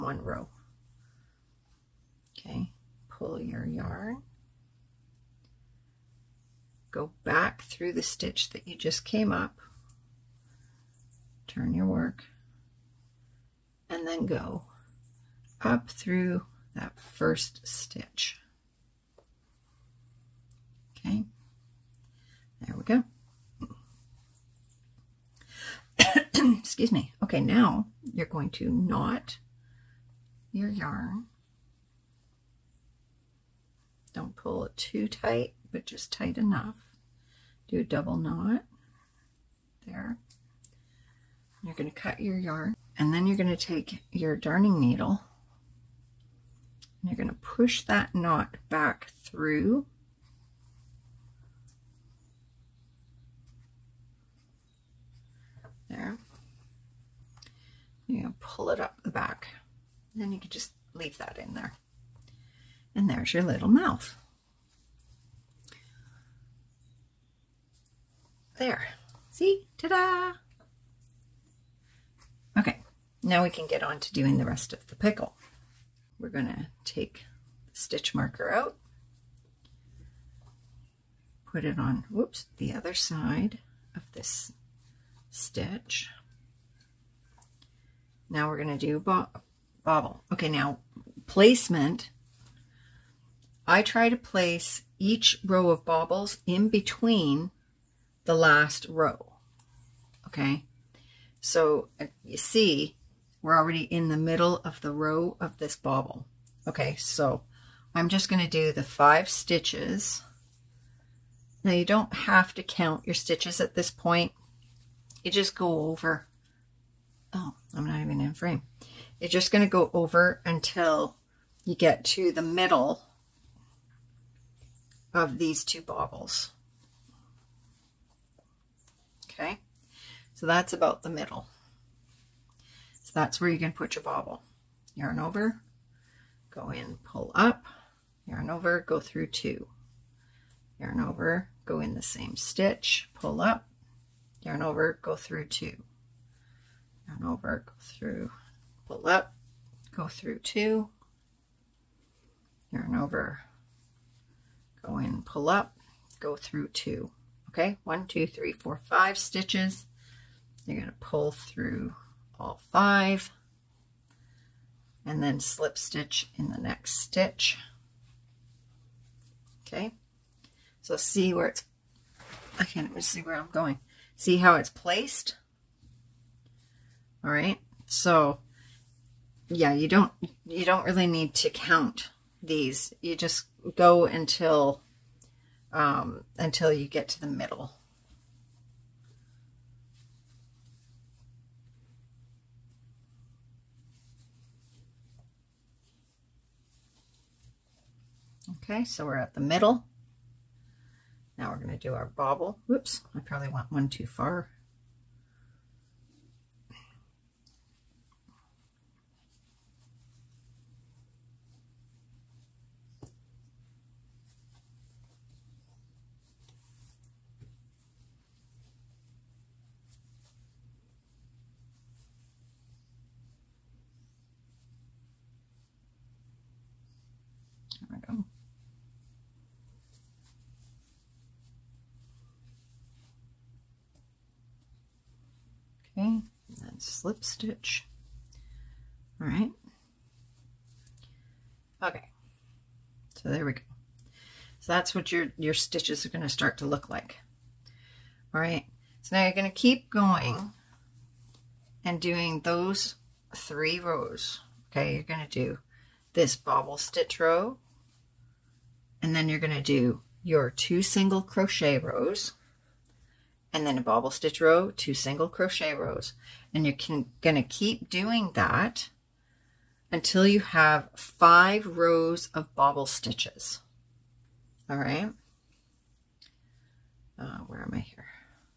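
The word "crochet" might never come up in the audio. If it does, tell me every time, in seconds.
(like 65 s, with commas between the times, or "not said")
261 s, 265 s.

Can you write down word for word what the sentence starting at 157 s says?
Okay, one, two, three, four, five stitches.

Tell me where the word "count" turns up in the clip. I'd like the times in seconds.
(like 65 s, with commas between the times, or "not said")
112 s, 181 s.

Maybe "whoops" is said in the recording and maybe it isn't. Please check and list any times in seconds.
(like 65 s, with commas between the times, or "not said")
82 s, 202 s.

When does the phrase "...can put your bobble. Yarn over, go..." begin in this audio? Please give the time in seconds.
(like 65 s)
133 s.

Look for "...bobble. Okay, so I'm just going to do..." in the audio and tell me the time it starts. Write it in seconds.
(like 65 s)
105 s.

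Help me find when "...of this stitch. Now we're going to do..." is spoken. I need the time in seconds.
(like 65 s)
83 s.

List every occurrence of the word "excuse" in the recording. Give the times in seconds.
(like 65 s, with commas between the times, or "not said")
26 s.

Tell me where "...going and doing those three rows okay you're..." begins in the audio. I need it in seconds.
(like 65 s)
249 s.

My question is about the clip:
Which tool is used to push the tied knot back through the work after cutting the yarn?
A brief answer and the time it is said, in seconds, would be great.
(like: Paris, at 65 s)
darning needle, at 44 s.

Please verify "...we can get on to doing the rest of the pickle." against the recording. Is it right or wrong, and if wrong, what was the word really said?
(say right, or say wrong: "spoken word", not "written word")
right.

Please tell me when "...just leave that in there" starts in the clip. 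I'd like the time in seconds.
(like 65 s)
60 s.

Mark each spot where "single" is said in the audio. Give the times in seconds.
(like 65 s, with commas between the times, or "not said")
260 s, 264 s.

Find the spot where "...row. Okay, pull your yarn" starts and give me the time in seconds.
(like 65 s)
0 s.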